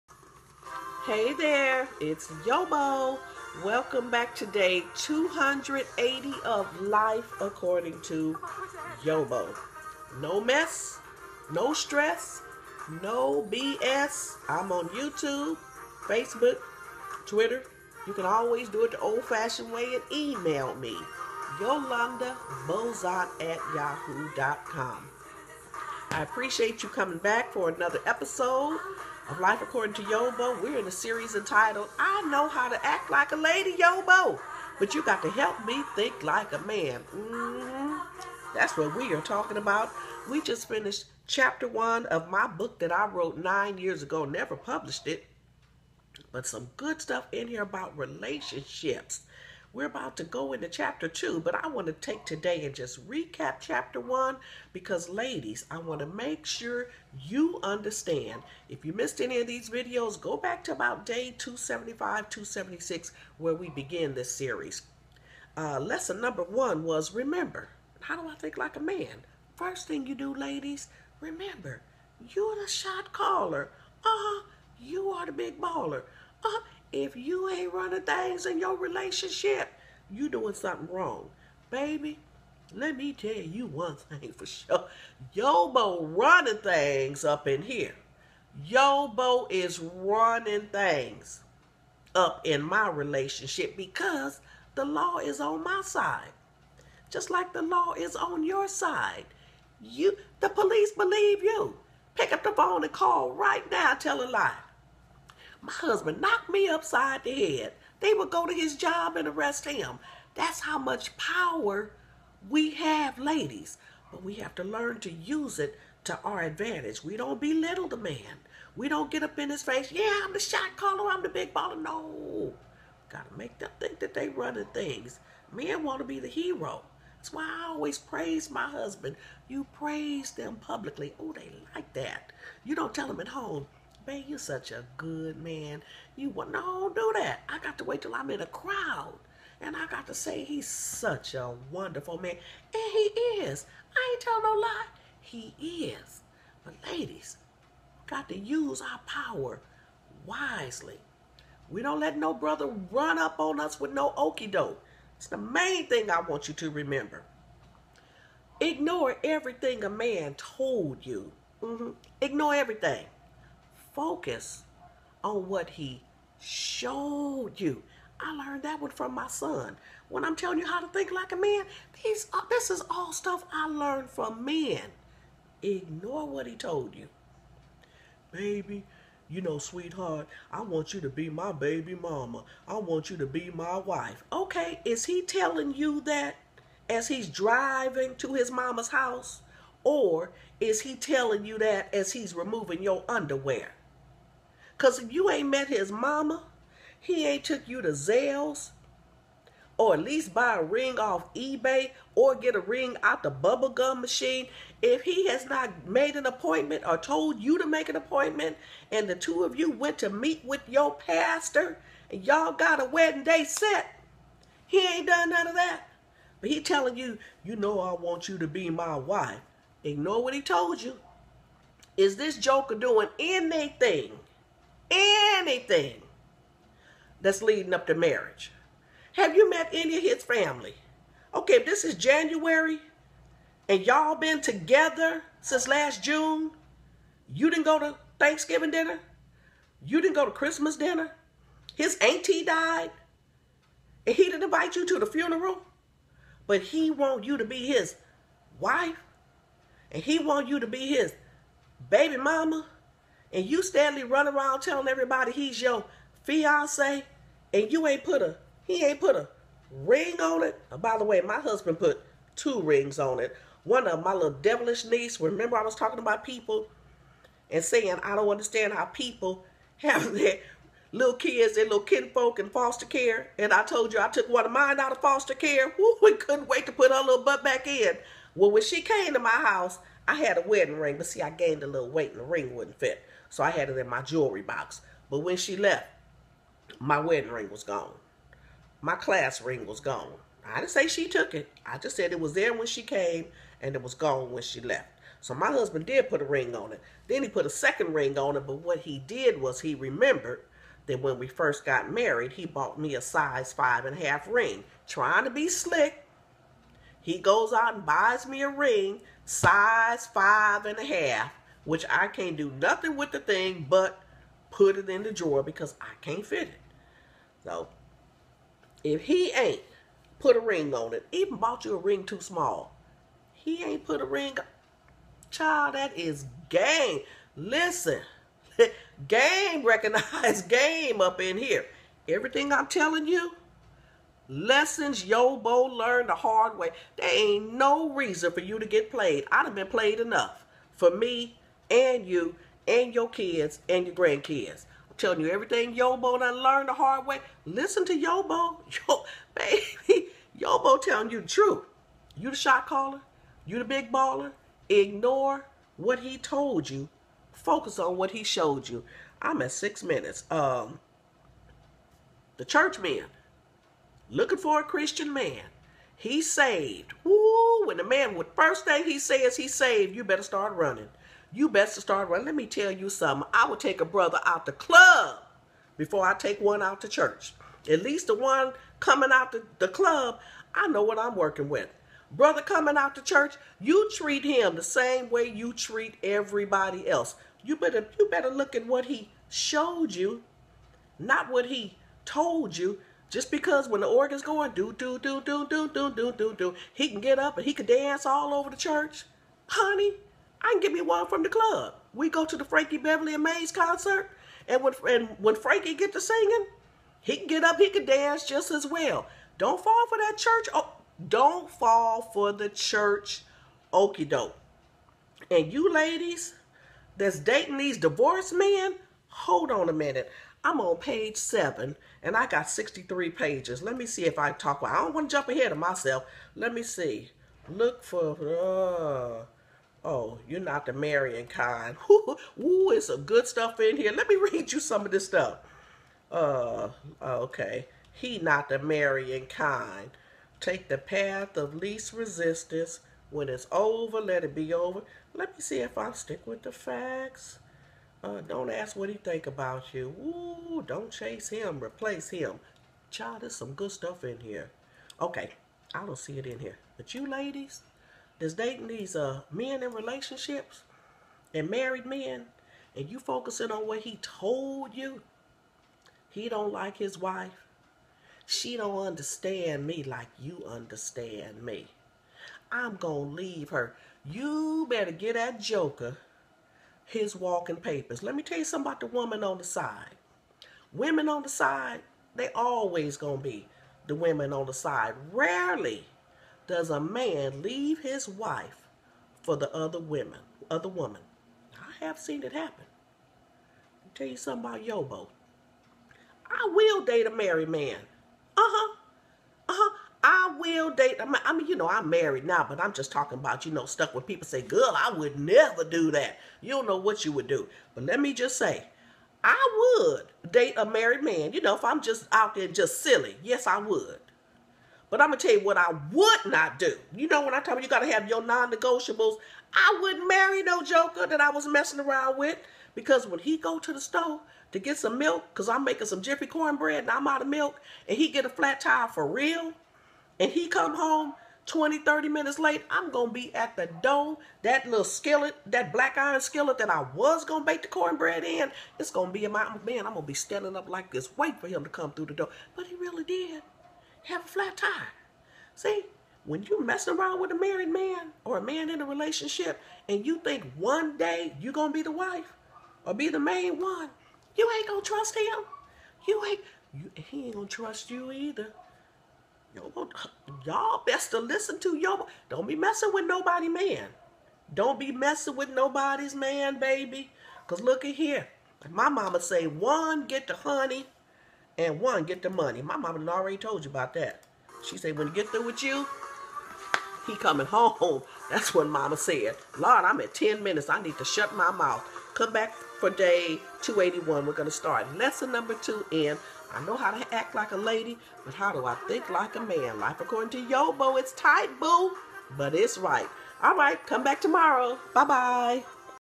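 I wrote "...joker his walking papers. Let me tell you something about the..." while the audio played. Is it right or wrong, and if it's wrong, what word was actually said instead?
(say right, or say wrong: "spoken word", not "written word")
right.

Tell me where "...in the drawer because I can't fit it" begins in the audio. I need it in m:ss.
5:14.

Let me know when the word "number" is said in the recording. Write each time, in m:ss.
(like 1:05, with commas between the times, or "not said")
1:06, 9:45.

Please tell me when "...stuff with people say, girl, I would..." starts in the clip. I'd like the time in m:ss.
8:23.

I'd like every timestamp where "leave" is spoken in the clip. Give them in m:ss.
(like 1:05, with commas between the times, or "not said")
7:53, 8:07.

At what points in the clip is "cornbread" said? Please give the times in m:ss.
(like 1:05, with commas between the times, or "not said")
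8:46, 8:57.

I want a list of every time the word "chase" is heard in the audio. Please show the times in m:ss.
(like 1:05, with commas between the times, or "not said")
7:30.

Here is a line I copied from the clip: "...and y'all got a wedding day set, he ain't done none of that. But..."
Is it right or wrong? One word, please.
right.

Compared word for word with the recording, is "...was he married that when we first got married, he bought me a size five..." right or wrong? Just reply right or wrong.
wrong.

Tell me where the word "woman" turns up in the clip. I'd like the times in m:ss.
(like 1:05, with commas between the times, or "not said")
7:58, 8:10.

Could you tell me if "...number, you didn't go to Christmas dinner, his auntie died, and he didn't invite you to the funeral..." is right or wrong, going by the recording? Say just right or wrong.
wrong.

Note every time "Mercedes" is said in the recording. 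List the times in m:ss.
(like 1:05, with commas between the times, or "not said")
not said.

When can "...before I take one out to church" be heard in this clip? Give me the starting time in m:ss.
6:15.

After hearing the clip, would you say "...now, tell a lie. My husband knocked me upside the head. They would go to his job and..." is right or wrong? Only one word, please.
right.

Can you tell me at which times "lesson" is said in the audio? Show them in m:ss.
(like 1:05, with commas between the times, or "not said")
1:05, 5:34, 9:44.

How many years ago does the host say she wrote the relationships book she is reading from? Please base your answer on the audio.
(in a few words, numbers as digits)
9.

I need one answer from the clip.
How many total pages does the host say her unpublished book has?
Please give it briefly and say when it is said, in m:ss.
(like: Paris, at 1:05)
63, at 7:02.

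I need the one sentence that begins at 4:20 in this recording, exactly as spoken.
by the way, my husband put two rings on it.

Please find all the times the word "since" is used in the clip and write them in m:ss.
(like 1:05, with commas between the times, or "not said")
3:55.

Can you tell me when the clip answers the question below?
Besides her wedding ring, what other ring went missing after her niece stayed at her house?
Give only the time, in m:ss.
4:48.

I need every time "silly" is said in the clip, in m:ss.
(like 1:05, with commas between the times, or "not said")
8:32.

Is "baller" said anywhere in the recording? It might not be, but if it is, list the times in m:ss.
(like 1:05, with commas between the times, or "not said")
1:15, 2:01, 5:53.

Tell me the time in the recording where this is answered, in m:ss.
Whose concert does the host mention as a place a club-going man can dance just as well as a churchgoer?
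6:42.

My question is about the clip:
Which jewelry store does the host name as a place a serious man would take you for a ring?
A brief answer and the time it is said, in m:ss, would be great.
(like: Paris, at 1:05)
Zales, at 3:17.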